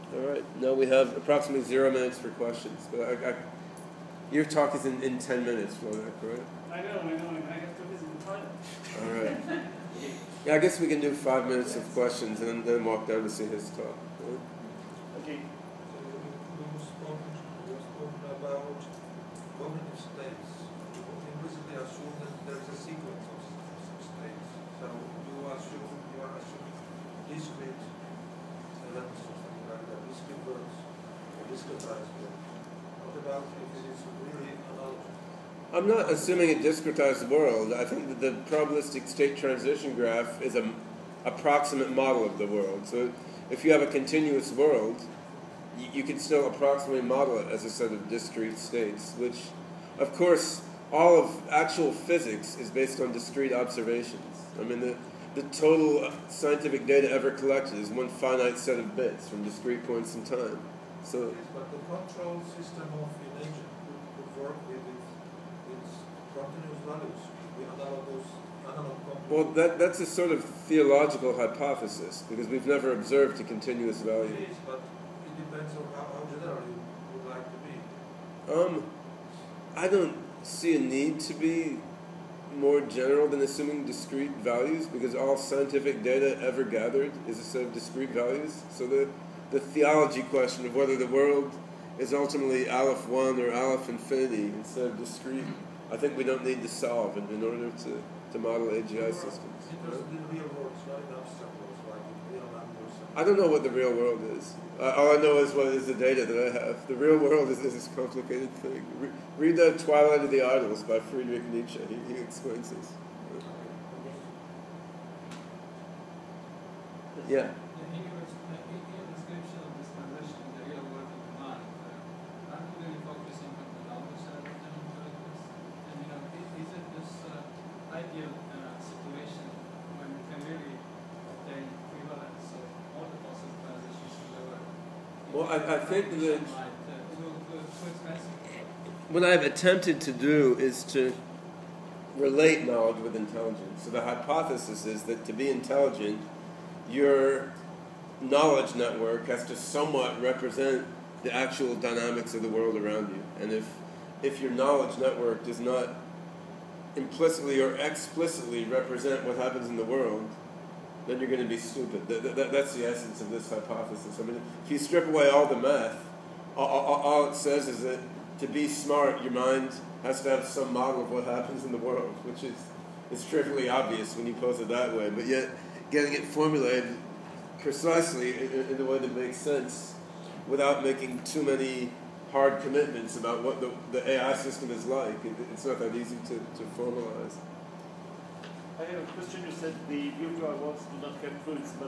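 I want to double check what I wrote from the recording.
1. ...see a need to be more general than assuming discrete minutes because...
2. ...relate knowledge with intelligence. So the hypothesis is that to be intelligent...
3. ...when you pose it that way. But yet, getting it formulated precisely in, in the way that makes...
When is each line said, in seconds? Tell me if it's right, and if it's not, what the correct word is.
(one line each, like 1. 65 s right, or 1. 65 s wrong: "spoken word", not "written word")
1. 80 s wrong: "values", not "minutes"
2. 142 s right
3. 174 s right.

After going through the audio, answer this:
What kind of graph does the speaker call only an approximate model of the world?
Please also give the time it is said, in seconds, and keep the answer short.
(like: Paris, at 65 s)
probabilistic state transition graph, at 38 s.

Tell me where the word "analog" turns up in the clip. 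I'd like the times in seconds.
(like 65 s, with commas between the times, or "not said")
68 s.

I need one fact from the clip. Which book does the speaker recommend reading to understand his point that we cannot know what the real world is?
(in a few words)
Twilight of the Idols.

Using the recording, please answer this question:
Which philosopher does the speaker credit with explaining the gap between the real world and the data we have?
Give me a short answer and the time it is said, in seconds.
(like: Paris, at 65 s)
Friedrich Nietzsche, at 110 s.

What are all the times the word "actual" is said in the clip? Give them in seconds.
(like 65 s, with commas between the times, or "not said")
51 s, 151 s.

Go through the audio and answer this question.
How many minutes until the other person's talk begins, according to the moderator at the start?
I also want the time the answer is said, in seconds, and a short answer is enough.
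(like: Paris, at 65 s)
10, at 5 s.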